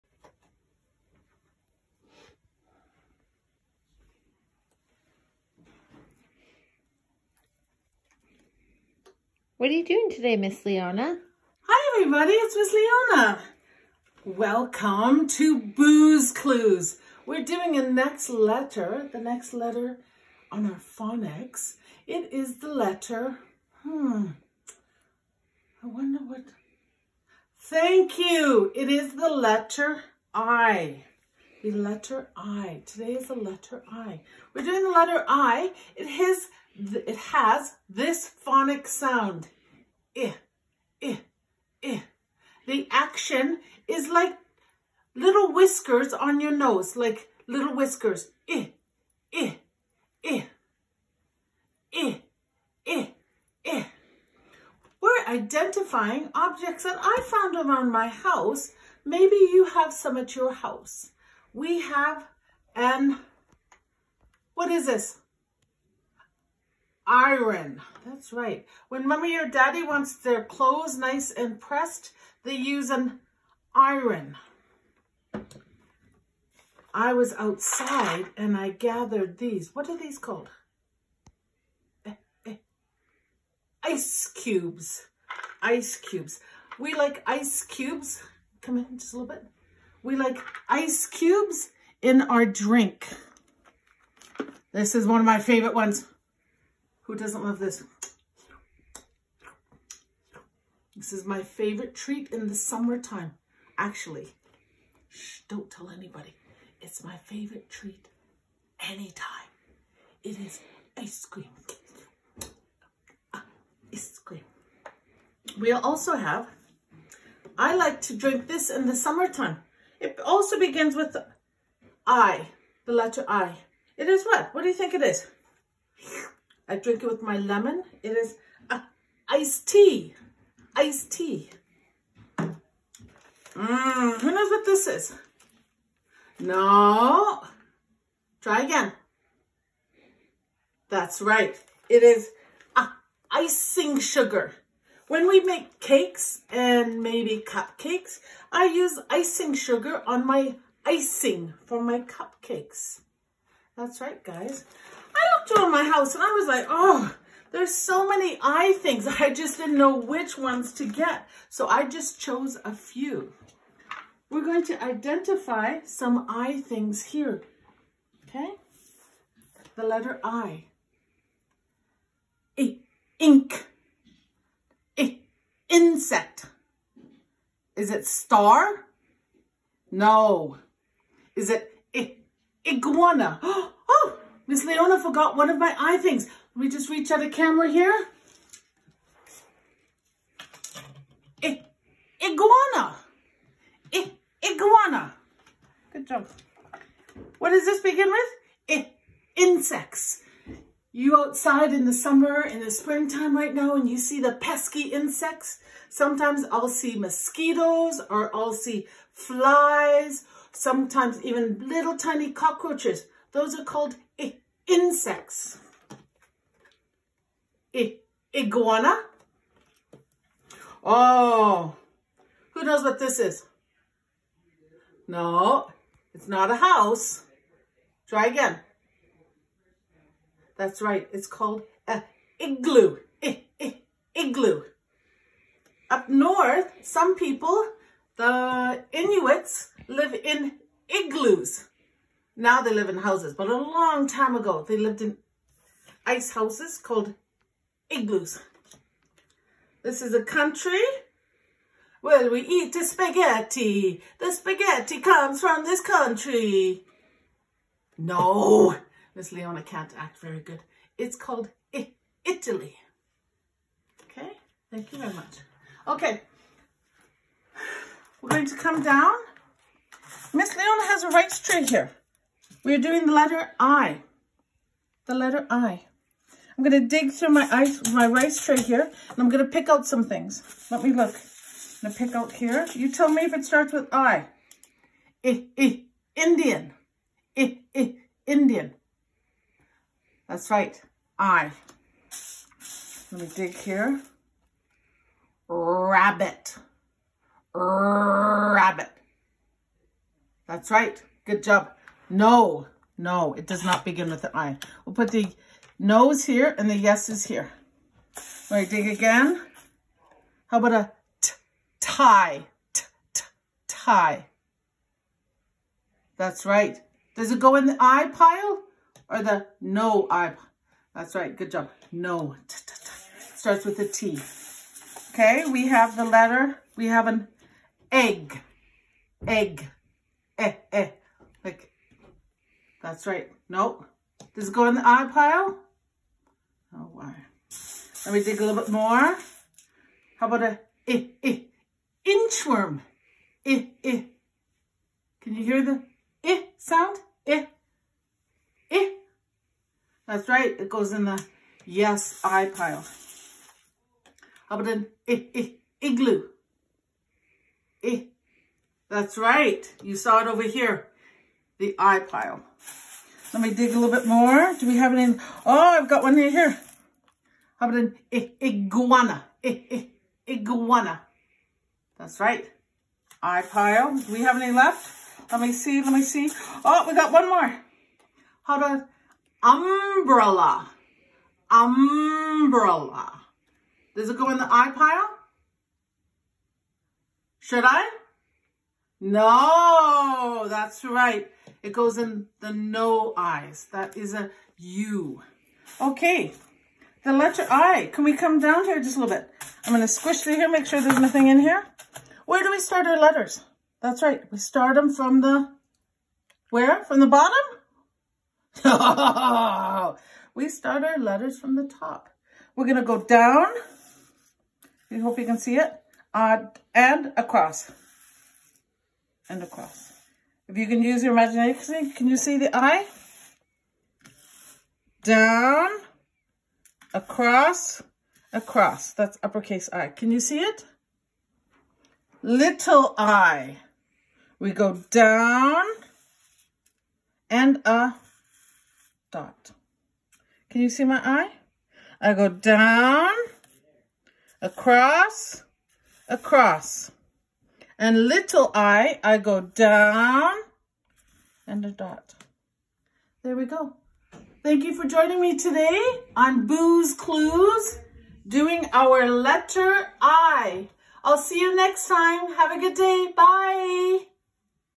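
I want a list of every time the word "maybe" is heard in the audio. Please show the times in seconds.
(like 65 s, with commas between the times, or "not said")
59 s, 147 s.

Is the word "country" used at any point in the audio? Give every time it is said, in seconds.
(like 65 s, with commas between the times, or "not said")
250 s, 255 s.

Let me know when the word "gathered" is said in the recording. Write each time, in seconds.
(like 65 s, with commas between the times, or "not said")
78 s.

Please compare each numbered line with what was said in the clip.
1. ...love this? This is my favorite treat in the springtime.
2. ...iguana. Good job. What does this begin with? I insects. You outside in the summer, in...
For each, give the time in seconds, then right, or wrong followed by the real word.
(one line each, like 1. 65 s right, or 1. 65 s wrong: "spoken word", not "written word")
1. 97 s wrong: "summertime", not "springtime"
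2. 194 s right.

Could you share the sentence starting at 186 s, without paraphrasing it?
Let me just reach out a camera here.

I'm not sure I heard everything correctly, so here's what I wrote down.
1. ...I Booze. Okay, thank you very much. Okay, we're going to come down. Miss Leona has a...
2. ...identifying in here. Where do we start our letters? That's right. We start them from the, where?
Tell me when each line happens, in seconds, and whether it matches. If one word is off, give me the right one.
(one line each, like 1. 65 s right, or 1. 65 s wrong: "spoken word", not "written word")
1. 261 s wrong: "Italy", not "Booze"
2. 400 s wrong: "nothing", not "identifying".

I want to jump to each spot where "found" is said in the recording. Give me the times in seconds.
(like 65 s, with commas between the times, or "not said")
57 s.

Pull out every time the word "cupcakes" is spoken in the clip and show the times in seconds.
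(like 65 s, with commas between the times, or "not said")
147 s, 151 s.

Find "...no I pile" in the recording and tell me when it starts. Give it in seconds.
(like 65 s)
319 s.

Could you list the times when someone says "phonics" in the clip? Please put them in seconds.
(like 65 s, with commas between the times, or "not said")
20 s, 38 s.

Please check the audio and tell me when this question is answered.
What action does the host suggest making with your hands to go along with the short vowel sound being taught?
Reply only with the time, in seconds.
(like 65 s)
45 s.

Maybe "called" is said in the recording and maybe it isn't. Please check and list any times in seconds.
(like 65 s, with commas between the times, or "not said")
80 s, 213 s, 231 s, 246 s, 261 s.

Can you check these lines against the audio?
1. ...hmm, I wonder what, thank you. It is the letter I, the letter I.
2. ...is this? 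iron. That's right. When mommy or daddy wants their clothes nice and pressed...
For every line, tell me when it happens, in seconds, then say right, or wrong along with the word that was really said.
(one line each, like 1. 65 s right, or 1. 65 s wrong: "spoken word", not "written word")
1. 23 s right
2. 64 s right.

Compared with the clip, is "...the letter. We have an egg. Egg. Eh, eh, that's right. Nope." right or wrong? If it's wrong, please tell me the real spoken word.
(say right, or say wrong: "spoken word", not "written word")
right.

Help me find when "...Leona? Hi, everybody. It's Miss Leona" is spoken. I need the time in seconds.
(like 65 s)
10 s.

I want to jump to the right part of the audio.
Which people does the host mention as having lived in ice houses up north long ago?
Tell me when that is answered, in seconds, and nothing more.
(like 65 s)
238 s.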